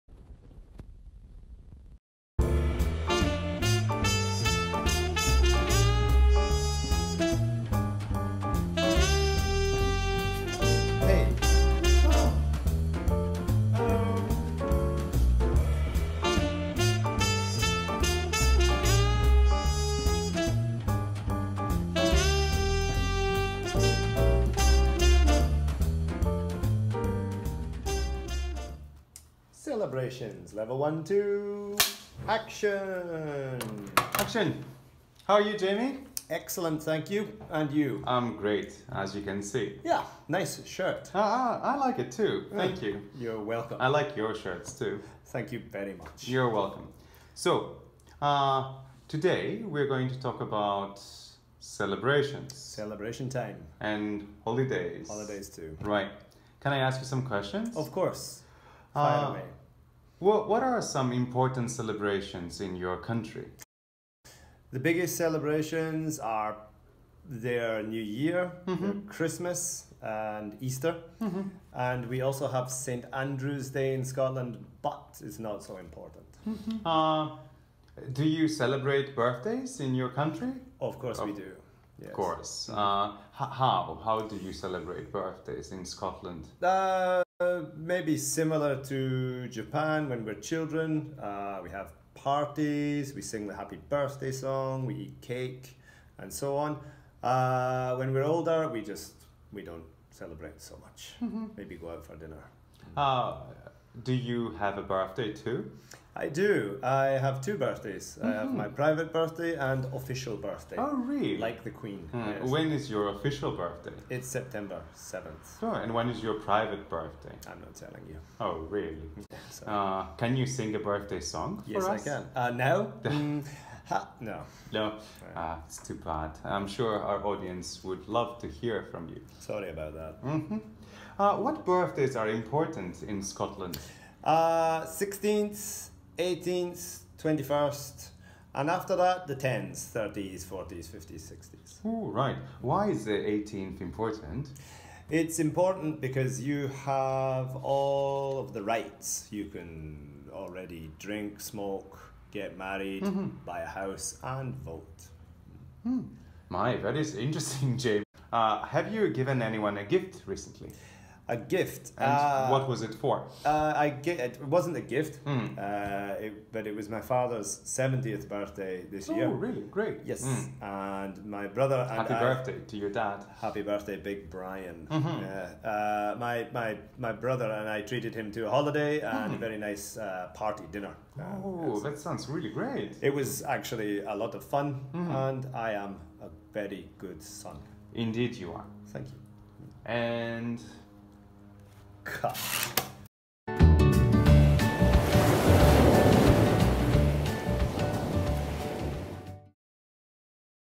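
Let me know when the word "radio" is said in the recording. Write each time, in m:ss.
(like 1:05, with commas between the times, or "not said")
not said.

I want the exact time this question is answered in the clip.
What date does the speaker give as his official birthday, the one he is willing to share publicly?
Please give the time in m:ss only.
1:54.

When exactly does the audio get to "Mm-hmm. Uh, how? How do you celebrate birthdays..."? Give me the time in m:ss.
1:22.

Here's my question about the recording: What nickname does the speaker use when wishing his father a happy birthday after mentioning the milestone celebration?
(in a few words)
Big Brian.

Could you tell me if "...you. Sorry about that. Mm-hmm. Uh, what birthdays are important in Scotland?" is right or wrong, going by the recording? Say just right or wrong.
right.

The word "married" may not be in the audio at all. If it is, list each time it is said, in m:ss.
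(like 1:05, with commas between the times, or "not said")
2:32.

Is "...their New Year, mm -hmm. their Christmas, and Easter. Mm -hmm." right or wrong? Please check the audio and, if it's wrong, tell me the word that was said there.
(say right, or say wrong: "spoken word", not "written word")
right.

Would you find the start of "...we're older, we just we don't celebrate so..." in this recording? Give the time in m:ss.
1:38.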